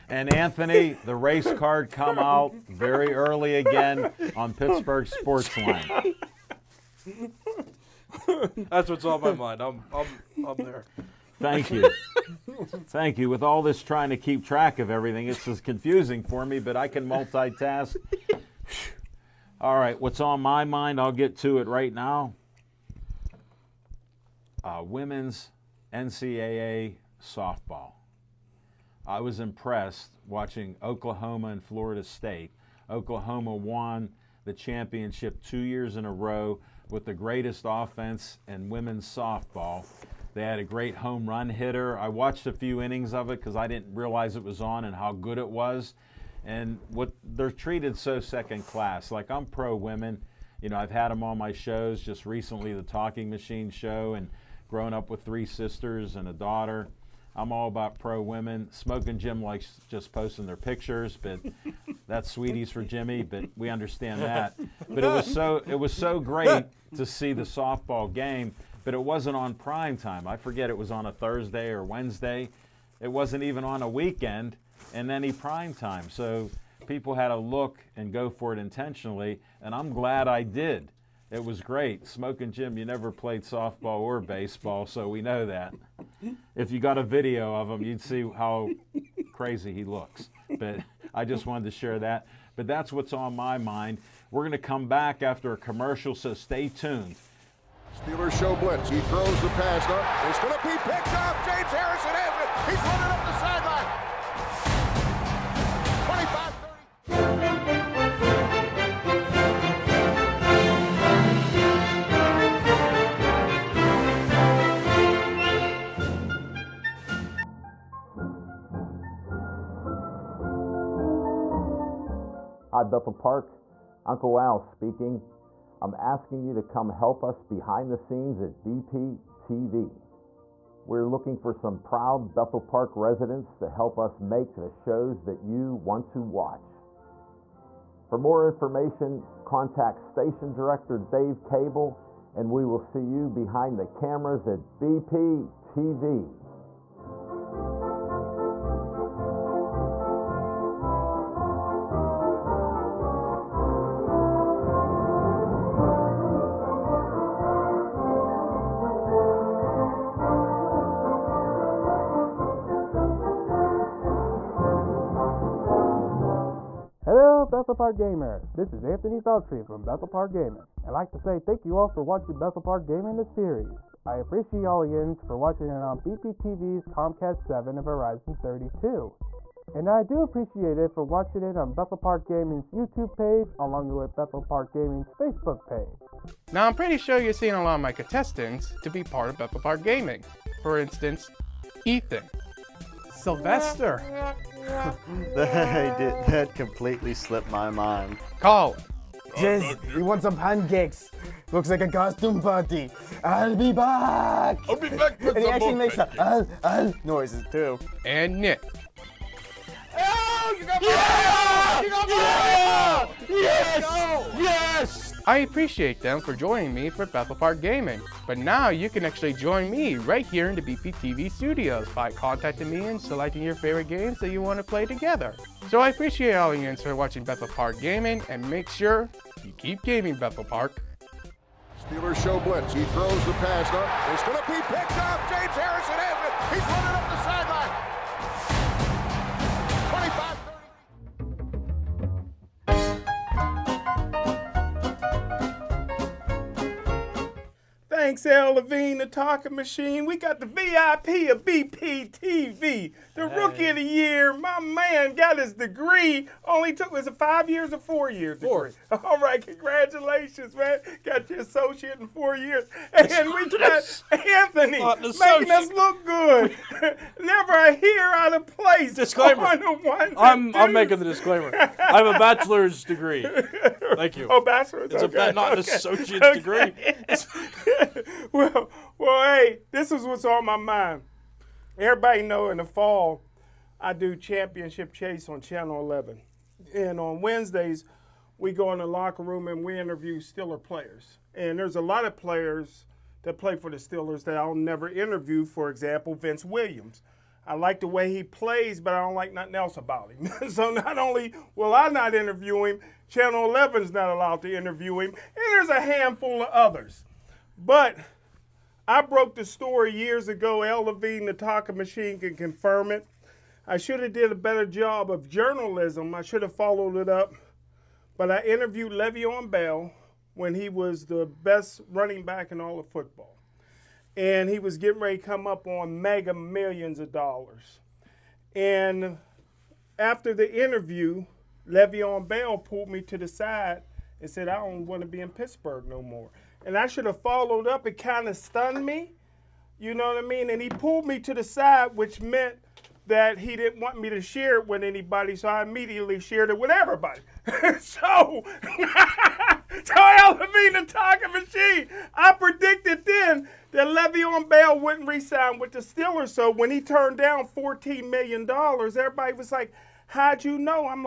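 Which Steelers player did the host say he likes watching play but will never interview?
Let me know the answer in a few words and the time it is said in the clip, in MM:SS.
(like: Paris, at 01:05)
Vince Williams, at 04:56.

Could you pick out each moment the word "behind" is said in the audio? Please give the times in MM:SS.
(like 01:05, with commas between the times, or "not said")
02:07, 02:23.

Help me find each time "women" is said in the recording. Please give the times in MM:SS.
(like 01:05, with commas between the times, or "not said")
00:24, 00:38, 00:49, 00:58.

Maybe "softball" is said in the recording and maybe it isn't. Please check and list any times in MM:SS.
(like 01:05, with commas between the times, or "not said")
00:27, 00:39, 01:07, 01:23.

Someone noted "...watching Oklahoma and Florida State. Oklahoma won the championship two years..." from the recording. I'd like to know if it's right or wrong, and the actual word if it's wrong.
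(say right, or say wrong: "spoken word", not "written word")
right.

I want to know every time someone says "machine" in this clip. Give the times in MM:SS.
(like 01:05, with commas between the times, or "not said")
00:53, 04:09, 05:11, 05:51.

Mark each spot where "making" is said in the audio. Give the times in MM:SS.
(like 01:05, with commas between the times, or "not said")
04:24, 04:30.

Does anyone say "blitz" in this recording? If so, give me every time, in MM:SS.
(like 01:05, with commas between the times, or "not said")
01:38, 03:52.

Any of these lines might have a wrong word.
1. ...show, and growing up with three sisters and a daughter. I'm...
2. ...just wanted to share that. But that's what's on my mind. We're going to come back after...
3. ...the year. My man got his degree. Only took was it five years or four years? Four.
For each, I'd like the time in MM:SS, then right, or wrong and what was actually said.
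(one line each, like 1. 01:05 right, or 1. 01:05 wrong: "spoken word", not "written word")
1. 00:53 right
2. 01:31 right
3. 04:13 right.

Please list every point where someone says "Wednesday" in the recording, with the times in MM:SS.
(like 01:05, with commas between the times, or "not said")
01:11, 04:47.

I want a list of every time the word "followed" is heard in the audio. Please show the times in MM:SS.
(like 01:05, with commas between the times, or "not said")
05:16, 05:37.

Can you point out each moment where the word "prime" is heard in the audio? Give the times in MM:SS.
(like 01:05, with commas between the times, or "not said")
01:09, 01:15.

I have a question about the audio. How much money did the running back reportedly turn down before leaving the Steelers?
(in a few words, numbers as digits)
$14 million.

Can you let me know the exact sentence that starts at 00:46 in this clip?
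And what they're treated so second class.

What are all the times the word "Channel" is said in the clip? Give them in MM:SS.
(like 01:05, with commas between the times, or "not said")
04:45, 05:03.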